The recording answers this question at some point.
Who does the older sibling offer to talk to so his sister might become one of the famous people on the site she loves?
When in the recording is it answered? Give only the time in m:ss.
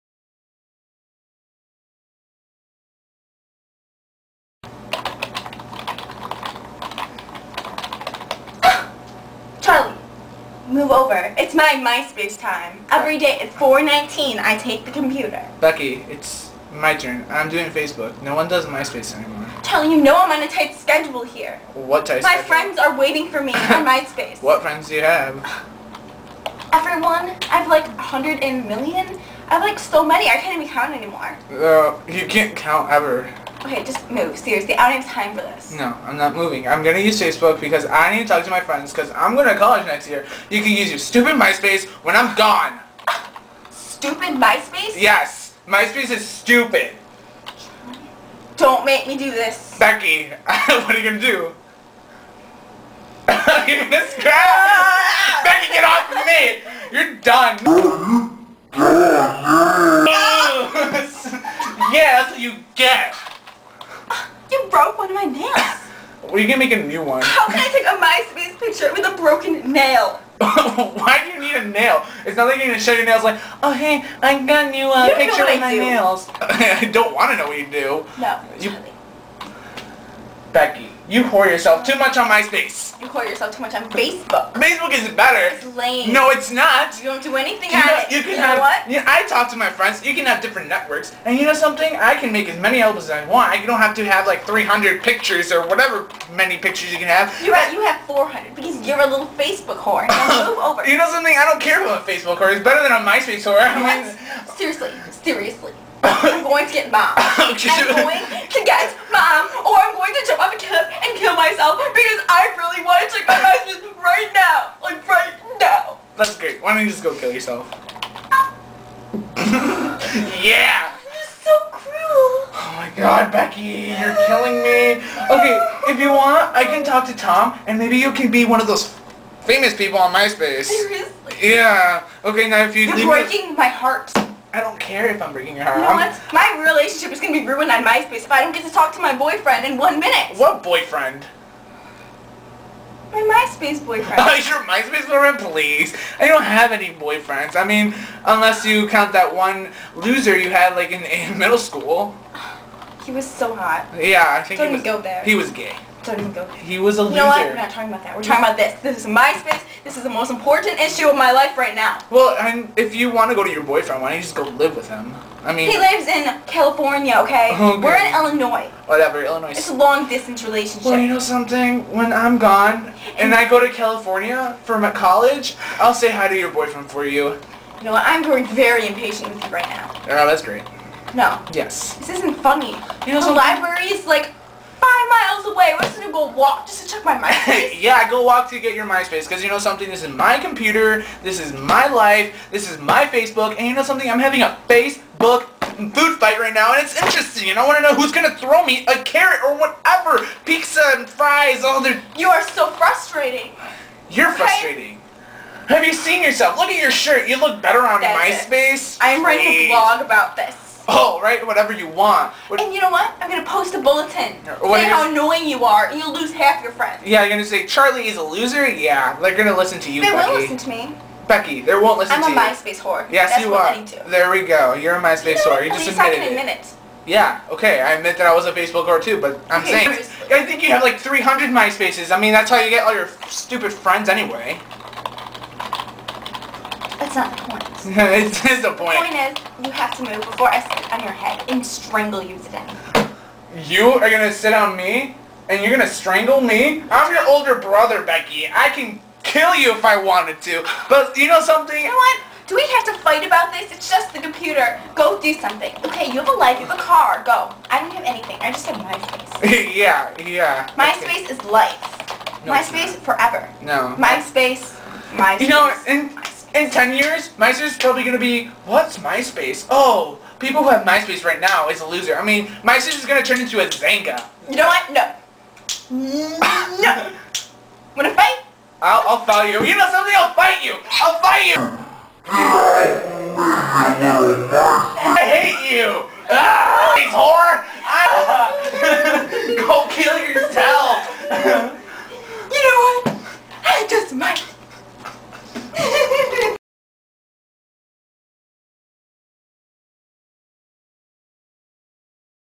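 2:07.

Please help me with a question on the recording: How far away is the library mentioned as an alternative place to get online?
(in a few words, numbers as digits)
5 miles.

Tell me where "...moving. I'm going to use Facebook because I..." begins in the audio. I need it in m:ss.
0:36.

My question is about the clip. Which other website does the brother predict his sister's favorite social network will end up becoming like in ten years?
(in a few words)
Xanga.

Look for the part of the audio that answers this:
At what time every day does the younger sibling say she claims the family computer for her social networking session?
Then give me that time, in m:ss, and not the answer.
0:13.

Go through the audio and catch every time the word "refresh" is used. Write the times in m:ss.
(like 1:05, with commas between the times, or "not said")
not said.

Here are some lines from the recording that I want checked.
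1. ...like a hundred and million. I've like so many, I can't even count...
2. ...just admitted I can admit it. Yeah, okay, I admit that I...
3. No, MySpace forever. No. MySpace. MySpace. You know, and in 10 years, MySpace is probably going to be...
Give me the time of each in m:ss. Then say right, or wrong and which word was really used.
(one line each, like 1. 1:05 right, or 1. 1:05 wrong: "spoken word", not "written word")
1. 0:27 right
2. 3:45 right
3. 4:22 right.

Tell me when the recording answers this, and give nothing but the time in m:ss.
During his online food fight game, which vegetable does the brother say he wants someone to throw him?
3:18.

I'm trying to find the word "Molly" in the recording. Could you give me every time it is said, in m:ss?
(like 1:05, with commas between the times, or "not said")
not said.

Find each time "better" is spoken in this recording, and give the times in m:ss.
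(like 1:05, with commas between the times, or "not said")
1:25, 1:42, 3:27.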